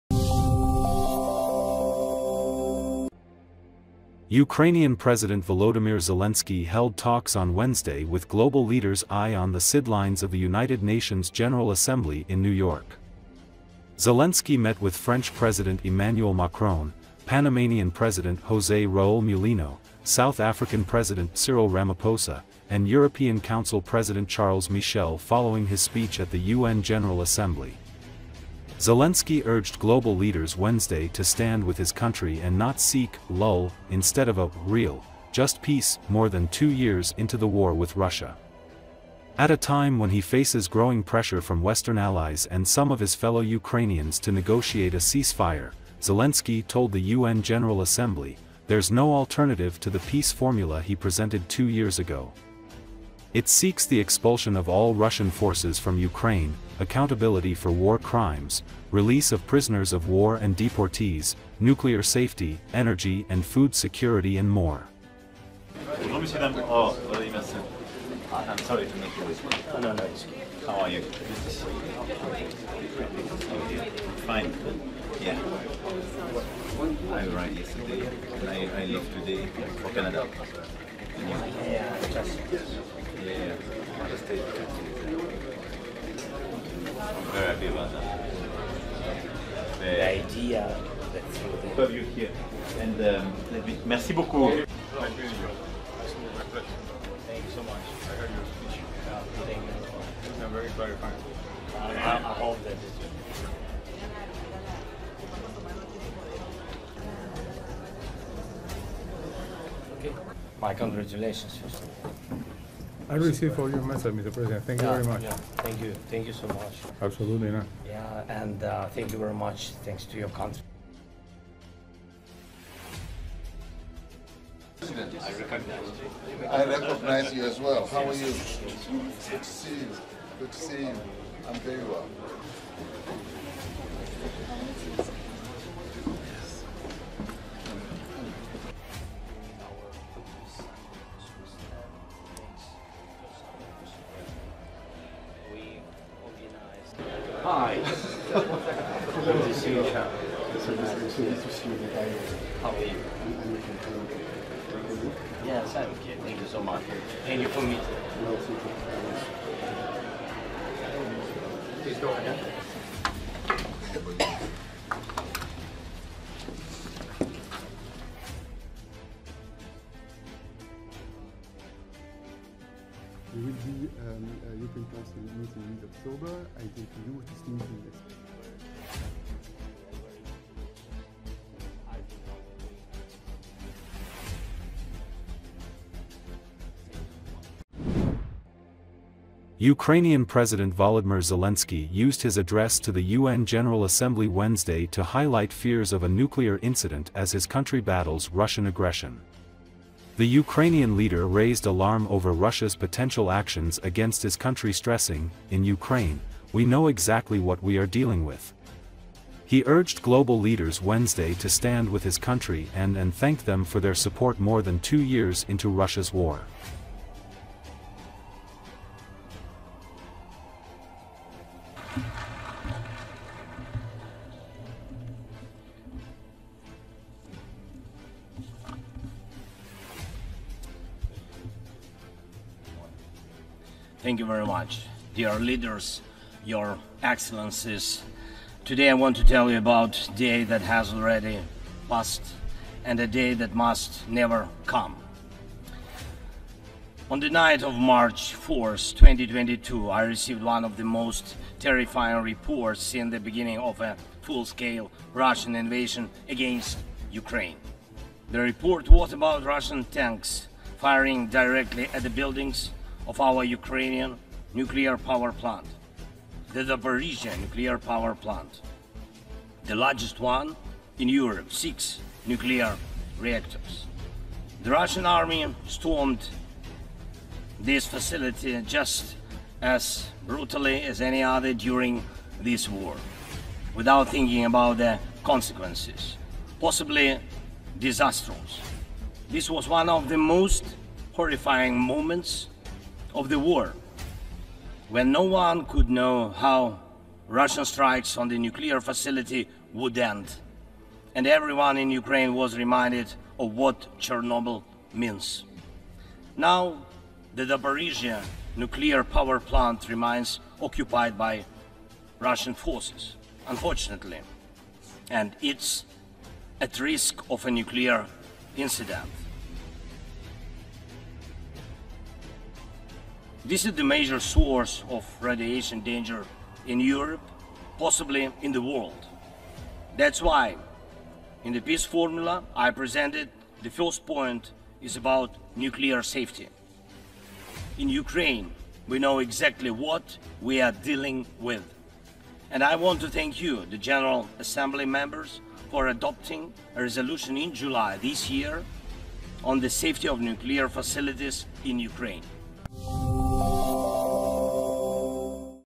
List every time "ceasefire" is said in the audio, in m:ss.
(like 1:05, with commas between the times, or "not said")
0:44.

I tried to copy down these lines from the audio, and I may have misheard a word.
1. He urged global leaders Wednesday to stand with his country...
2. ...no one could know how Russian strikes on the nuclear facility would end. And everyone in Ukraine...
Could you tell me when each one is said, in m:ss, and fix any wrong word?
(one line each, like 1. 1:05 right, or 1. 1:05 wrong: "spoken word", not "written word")
1. 3:29 right
2. 4:55 right.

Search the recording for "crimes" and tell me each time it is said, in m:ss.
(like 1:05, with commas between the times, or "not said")
0:57.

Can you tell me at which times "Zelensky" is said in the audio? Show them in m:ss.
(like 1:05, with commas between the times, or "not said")
0:05, 0:13, 0:28, 0:46, 3:11.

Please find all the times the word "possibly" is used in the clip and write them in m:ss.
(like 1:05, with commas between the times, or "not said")
4:46, 5:27.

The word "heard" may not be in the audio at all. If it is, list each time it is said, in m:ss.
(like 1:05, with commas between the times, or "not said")
1:38.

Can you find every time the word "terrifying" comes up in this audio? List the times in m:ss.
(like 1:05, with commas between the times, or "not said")
4:11.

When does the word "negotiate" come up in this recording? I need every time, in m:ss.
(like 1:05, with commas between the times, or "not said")
0:44.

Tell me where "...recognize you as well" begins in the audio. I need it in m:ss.
2:06.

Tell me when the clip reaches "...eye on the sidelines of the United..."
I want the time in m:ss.
0:09.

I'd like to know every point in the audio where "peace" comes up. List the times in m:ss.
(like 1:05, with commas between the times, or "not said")
0:35, 0:50, 5:31.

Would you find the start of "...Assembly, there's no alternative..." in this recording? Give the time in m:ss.
0:47.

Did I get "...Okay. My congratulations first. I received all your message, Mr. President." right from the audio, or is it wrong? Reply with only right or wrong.
right.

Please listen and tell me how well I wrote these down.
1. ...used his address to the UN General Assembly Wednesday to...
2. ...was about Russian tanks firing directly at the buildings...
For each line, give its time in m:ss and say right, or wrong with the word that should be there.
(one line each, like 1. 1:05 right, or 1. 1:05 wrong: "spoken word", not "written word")
1. 3:11 right
2. 4:18 right.